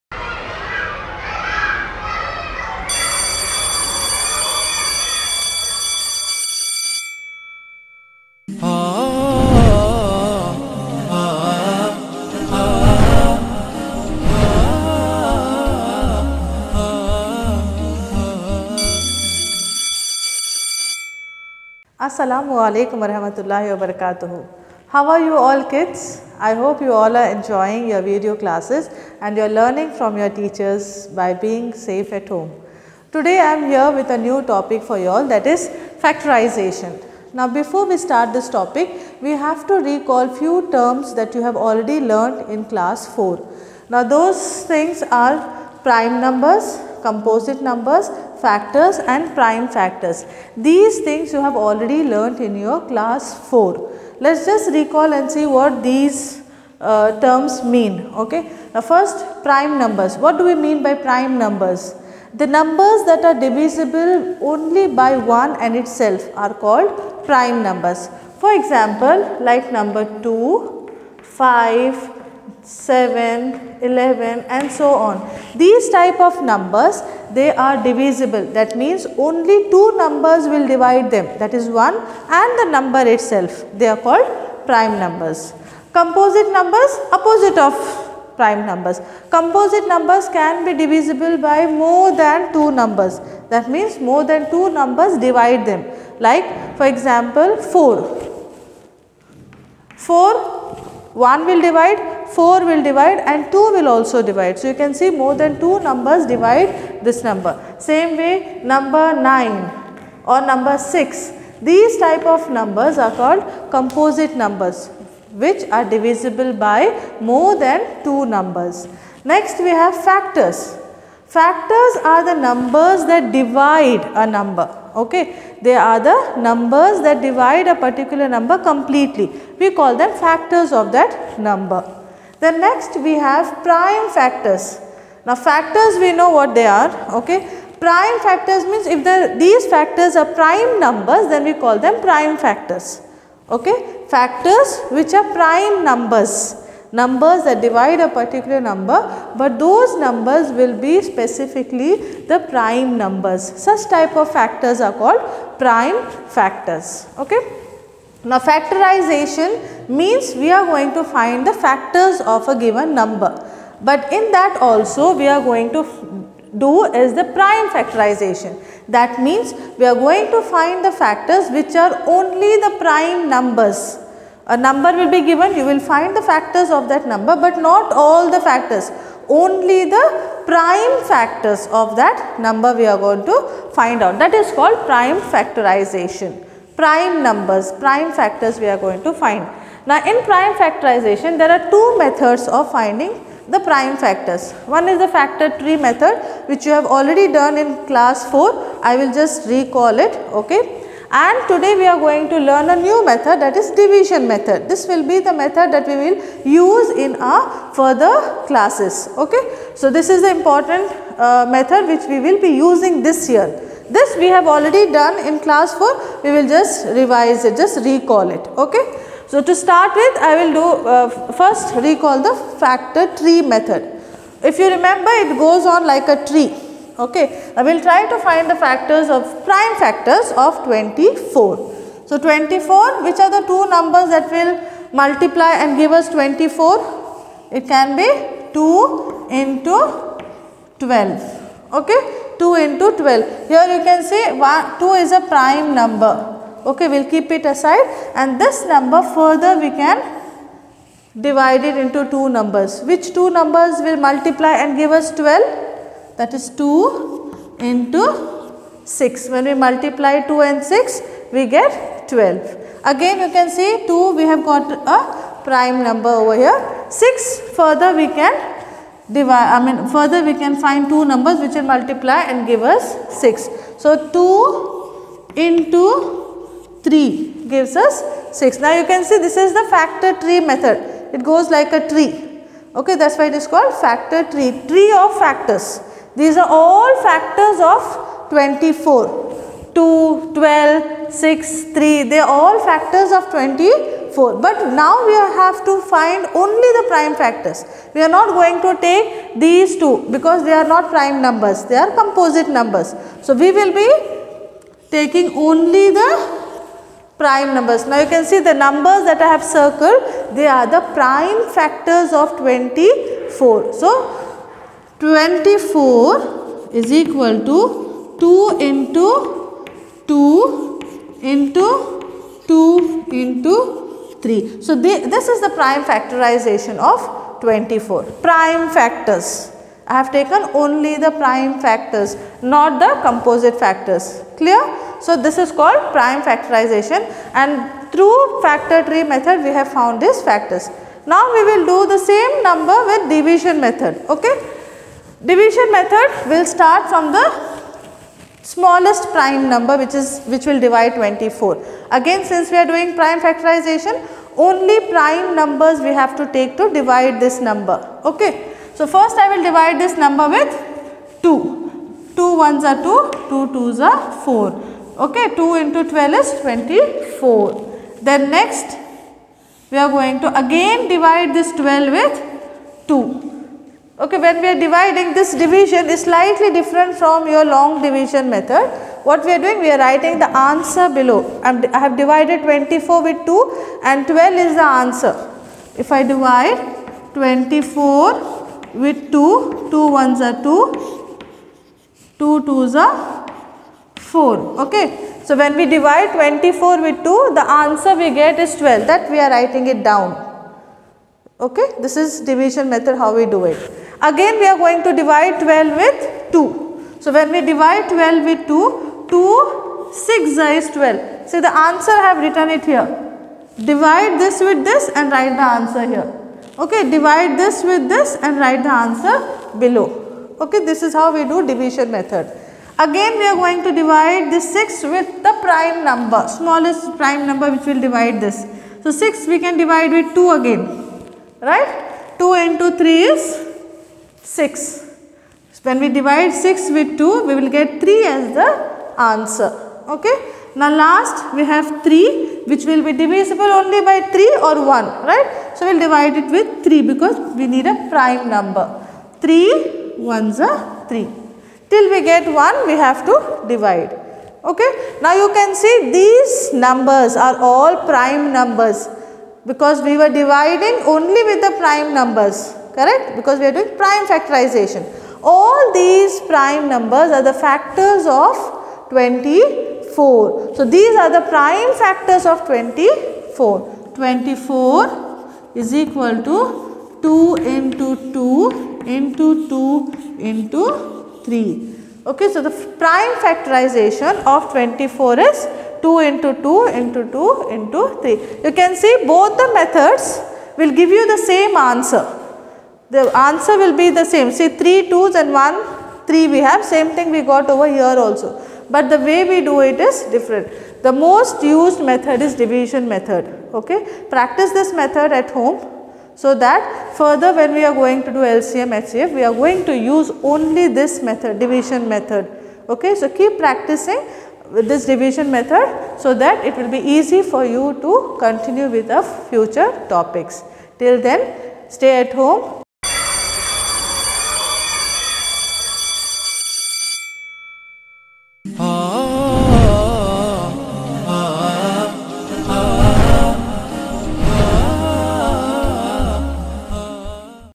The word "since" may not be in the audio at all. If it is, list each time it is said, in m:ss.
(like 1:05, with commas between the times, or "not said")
5:52.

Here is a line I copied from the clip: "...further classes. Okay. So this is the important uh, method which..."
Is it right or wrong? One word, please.
right.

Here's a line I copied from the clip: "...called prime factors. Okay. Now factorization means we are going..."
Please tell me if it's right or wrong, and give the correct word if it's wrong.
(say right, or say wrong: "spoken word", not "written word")
right.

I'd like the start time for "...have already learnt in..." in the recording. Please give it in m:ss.
0:51.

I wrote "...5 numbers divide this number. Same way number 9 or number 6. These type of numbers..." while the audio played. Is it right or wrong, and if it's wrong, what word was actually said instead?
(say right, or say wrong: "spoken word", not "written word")
wrong: "2", not "5".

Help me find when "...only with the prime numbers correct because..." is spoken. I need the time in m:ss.
7:40.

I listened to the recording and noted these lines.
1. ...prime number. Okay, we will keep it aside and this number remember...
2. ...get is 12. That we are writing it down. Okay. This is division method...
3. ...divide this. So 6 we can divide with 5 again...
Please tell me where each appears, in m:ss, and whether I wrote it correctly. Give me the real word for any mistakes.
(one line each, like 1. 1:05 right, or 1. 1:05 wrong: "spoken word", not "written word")
1. 4:05 wrong: "further", not "remember"
2. 6:38 right
3. 7:07 wrong: "2", not "5".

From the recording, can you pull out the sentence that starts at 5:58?
So first I will divide this number with 2.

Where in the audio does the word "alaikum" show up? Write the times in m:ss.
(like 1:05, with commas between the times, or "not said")
0:22.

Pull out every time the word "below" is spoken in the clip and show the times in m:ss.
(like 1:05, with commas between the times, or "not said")
6:20, 6:59.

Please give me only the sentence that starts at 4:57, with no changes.
We are not going to take these two because they are not prime numbers.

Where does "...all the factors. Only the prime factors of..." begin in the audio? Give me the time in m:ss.
2:57.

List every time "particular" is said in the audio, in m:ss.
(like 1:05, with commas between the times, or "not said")
2:07, 2:28.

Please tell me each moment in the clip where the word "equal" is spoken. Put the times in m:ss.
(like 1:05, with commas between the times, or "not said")
5:16, 7:55.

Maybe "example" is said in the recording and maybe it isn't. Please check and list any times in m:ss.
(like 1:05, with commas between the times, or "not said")
1:08, 1:36.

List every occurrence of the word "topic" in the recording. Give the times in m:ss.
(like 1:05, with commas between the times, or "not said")
0:34, 0:38, 8:39.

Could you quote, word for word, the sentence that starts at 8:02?
Okay, so the prime factorization of 24 is 2 into 2 into 2 into 3.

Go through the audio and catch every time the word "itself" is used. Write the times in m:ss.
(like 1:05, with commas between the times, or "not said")
1:05, 1:23.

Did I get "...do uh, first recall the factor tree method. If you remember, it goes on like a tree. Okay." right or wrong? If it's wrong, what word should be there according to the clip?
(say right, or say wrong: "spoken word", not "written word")
right.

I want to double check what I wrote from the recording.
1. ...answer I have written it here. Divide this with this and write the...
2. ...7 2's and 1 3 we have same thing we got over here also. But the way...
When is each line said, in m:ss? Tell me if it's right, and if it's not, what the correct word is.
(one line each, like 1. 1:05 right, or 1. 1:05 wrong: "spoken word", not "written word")
1. 6:51 right
2. 8:14 wrong: "3", not "7".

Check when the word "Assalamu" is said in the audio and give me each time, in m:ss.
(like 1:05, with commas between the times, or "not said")
0:22.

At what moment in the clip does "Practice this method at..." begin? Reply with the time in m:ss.
8:24.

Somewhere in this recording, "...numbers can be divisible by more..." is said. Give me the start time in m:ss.
1:29.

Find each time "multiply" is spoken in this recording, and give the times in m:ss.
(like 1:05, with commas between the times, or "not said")
3:54, 4:14, 4:19, 4:31.